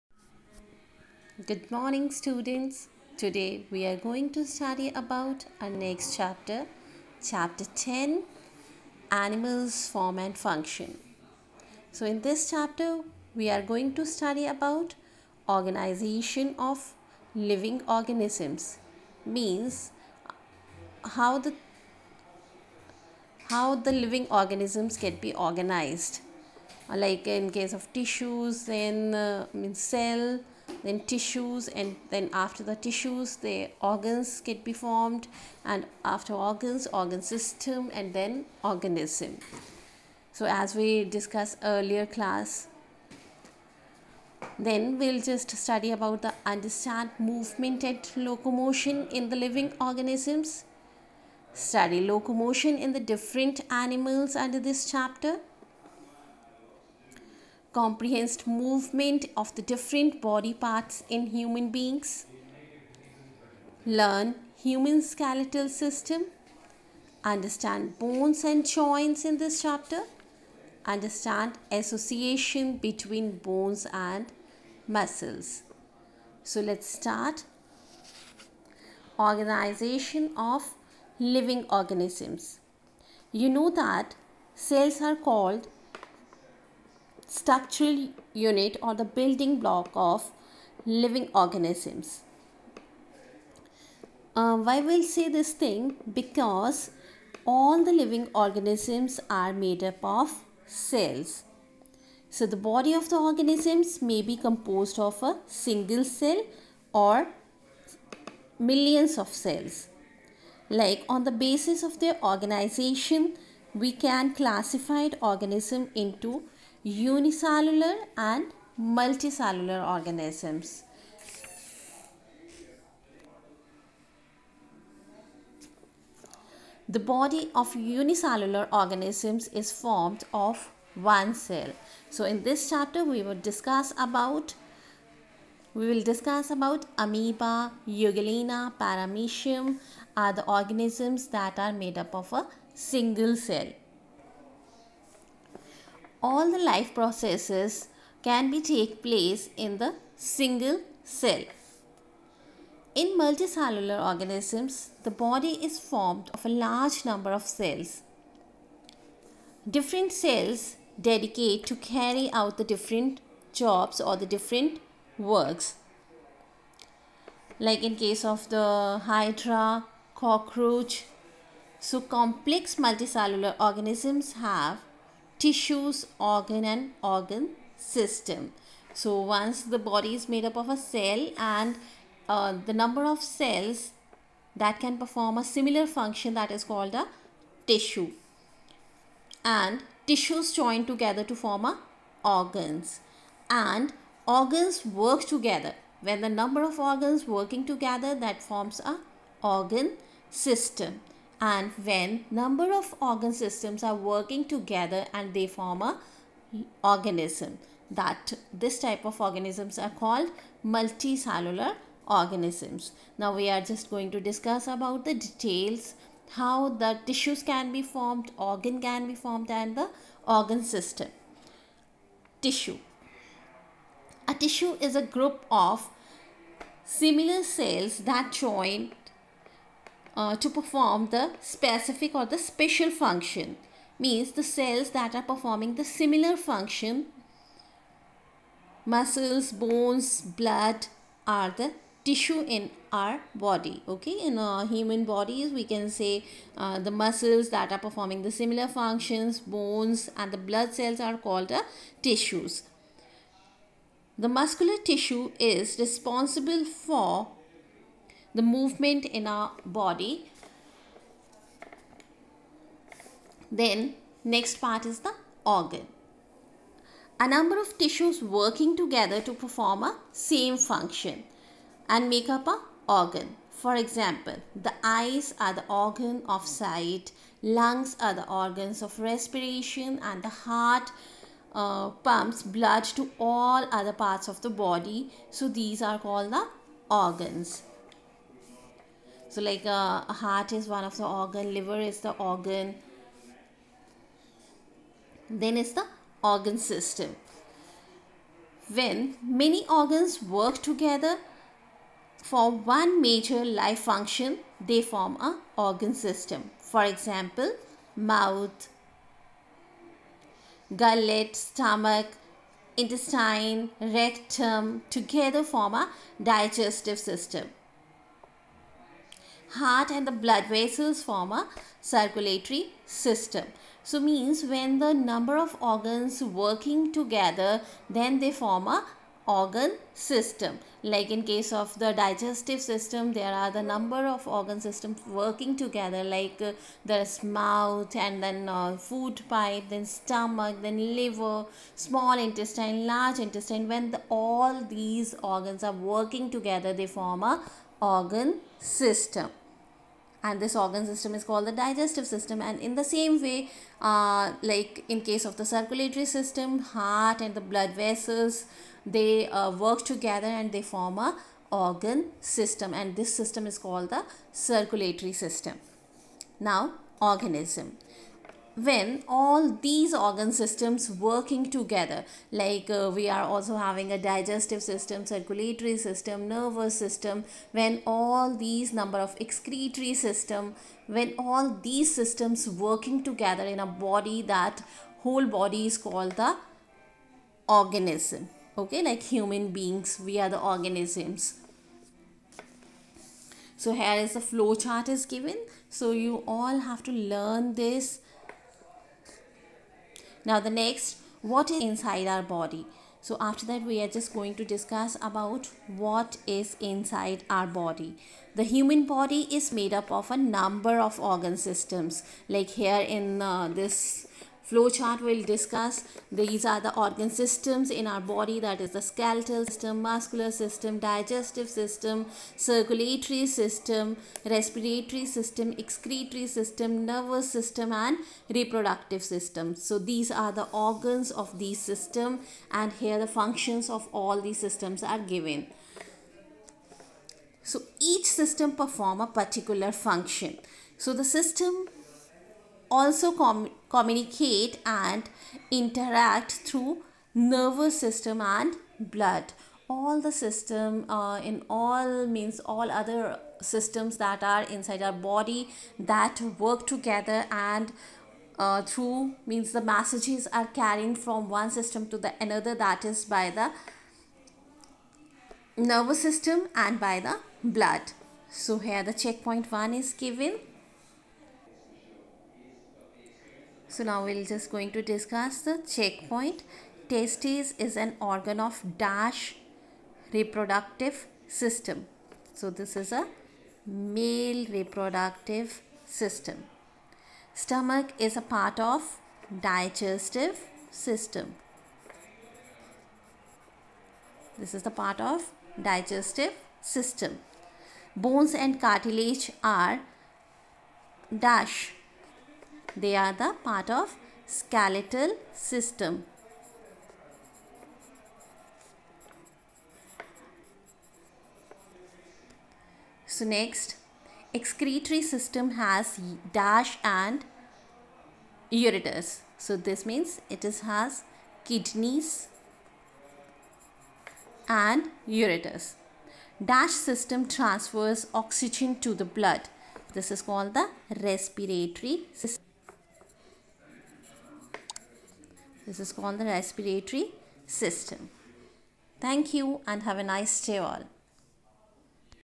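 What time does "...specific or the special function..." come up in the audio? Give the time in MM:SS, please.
03:51.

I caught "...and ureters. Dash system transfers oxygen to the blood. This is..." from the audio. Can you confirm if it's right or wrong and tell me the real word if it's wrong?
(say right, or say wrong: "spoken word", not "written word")
right.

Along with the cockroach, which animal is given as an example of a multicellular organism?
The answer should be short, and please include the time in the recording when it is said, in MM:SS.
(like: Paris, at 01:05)
Hydra, at 02:49.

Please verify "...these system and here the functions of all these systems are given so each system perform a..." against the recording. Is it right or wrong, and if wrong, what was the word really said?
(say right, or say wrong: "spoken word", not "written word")
right.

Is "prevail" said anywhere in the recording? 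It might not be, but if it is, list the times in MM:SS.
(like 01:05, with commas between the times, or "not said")
not said.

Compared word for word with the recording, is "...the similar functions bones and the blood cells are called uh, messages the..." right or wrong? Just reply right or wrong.
wrong.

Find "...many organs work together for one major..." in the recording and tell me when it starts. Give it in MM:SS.
04:59.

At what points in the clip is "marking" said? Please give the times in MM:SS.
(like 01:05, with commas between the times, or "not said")
not said.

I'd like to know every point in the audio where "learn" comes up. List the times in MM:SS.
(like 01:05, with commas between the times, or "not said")
01:03, 06:36.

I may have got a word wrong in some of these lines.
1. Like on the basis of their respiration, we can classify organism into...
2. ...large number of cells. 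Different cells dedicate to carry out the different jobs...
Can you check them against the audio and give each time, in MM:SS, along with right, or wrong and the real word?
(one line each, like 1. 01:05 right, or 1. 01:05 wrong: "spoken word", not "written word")
1. 01:50 wrong: "organization", not "respiration"
2. 02:36 right.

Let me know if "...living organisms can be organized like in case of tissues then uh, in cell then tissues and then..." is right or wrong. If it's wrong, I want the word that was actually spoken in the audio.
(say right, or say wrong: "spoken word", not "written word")
right.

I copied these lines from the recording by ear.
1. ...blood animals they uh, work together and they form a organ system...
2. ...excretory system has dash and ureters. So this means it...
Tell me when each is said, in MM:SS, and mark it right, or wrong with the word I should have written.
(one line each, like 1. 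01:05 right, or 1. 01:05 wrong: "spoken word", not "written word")
1. 05:57 wrong: "vessels", not "animals"
2. 08:34 right.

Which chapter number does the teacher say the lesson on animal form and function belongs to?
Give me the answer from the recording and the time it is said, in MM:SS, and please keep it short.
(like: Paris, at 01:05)
10, at 00:07.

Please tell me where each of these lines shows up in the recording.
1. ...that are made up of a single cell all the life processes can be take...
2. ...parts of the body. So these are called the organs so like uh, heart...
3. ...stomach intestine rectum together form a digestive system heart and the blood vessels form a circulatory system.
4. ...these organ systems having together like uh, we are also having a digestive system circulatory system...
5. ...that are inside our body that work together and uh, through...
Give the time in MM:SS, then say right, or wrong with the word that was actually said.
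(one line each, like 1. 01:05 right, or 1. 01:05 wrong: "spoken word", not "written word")
1. 02:21 right
2. 04:43 right
3. 05:11 right
4. 06:09 wrong: "working", not "having"
5. 07:33 right.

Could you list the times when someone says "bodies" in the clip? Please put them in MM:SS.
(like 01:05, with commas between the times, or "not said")
04:05.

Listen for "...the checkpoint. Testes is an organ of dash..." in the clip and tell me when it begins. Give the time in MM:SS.
07:55.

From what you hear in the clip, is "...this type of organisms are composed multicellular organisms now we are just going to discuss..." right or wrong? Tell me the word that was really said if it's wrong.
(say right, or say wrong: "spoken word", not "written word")
wrong: "called", not "composed".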